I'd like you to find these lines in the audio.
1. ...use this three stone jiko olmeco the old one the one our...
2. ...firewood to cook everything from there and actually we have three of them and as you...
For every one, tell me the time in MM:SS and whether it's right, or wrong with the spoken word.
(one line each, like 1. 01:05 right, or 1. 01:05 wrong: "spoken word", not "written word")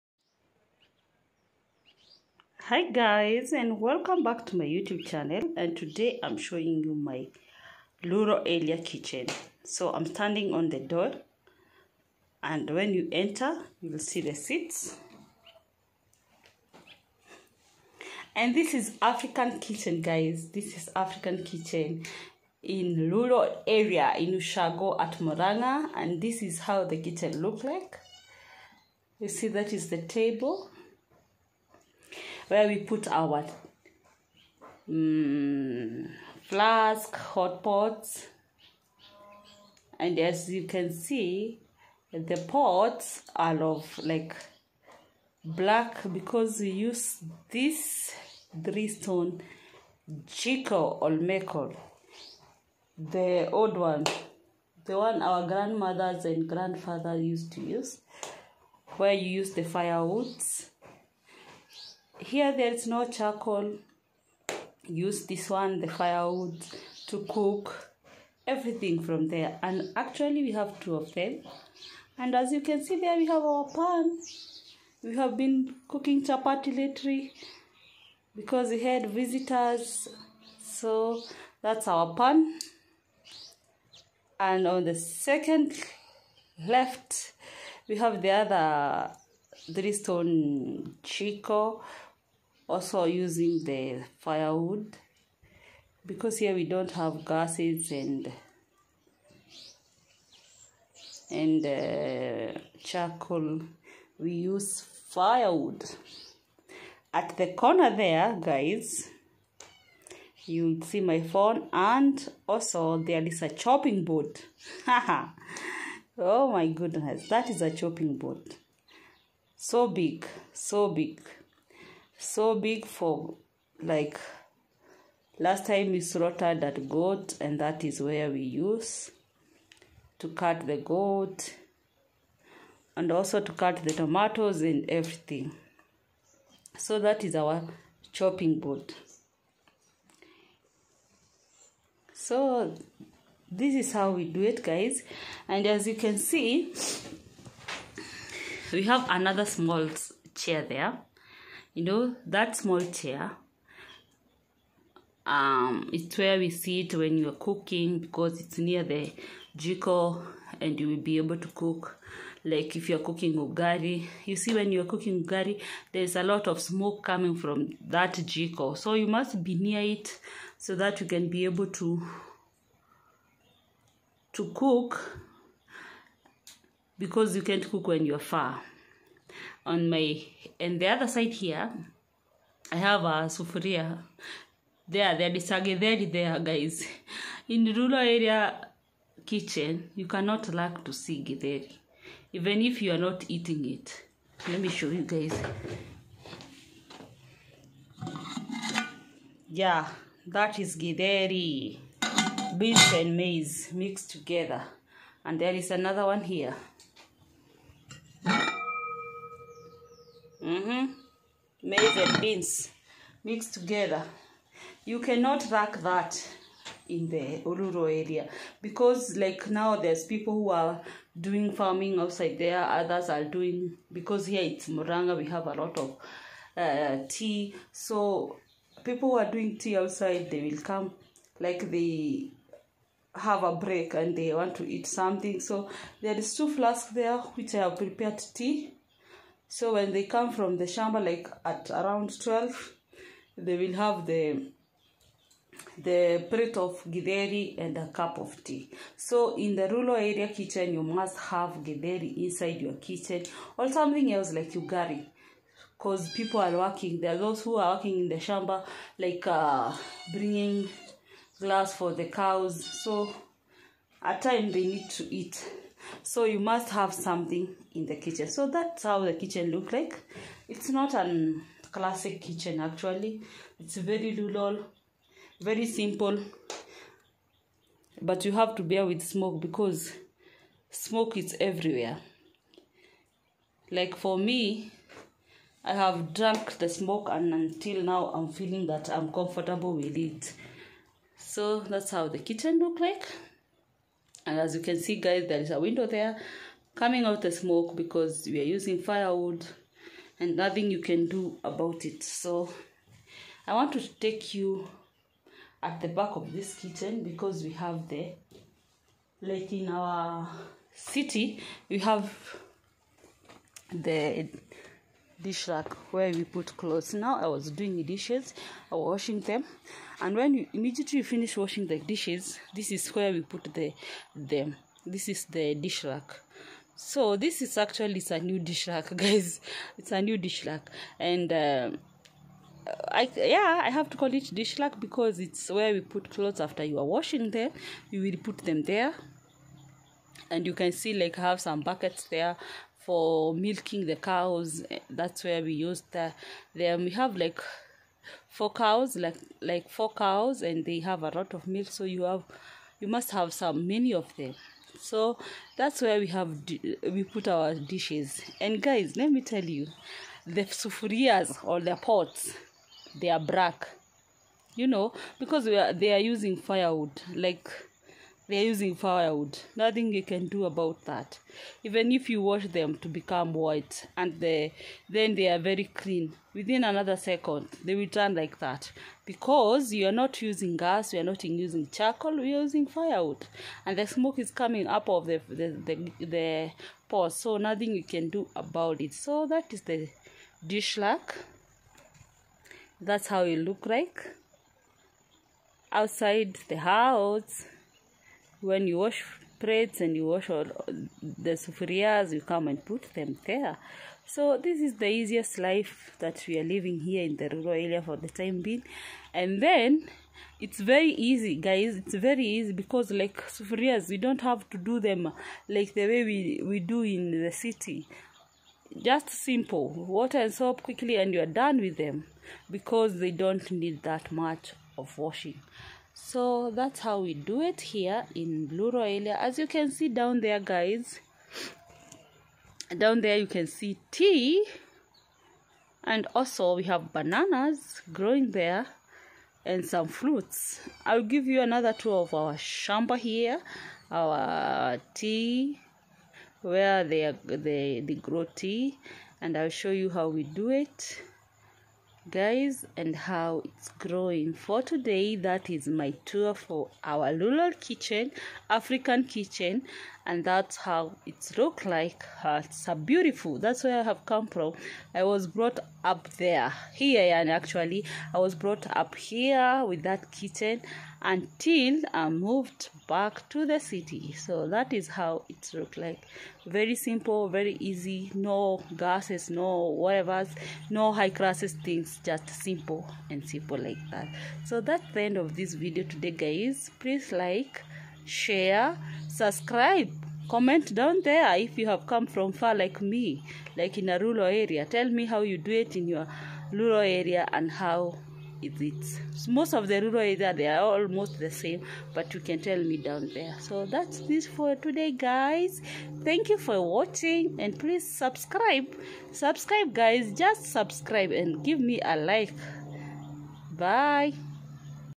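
1. 00:46 right
2. 01:05 wrong: "two", not "three".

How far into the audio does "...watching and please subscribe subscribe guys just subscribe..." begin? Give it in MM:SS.
08:26.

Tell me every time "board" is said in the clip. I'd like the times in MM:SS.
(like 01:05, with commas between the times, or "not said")
01:54, 01:58, 02:18.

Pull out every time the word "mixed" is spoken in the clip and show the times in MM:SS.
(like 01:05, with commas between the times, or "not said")
03:23, 03:33.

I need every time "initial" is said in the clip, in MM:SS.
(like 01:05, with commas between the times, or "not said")
not said.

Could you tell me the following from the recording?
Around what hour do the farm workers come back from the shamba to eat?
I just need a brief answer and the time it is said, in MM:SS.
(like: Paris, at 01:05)
12, at 04:02.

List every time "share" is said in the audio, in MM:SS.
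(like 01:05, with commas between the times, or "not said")
08:08.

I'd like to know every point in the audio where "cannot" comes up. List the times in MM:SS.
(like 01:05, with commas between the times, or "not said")
03:10, 03:34.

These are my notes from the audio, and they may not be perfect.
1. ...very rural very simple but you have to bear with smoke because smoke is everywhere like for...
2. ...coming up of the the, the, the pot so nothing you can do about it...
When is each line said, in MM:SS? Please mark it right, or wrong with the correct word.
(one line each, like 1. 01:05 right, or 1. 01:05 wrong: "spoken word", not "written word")
1. 04:33 right
2. 06:24 right.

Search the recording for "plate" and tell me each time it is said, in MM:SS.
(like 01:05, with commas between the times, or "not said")
04:06, 06:39.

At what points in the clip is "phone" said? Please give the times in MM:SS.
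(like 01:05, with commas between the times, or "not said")
01:51.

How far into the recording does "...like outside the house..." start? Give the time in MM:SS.
06:33.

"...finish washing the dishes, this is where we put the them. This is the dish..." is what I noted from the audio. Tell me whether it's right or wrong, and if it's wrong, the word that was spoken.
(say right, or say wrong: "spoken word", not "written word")
right.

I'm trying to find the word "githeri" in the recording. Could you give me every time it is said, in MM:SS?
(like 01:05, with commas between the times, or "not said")
03:11, 03:20, 04:06, 04:11.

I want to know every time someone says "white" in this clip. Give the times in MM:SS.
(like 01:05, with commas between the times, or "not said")
06:13.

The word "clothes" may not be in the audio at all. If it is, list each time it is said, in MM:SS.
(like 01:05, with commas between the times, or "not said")
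05:16, 05:36.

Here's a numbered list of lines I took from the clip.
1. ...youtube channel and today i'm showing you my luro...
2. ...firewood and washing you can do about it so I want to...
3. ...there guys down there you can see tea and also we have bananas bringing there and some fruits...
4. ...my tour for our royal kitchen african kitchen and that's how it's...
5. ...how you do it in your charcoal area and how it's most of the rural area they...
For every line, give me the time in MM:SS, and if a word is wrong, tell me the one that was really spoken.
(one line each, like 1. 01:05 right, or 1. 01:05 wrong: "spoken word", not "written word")
1. 00:04 right
2. 04:58 wrong: "nothing", not "washing"
3. 07:10 wrong: "growing", not "bringing"
4. 07:35 wrong: "rural", not "royal"
5. 08:15 wrong: "rural", not "charcoal".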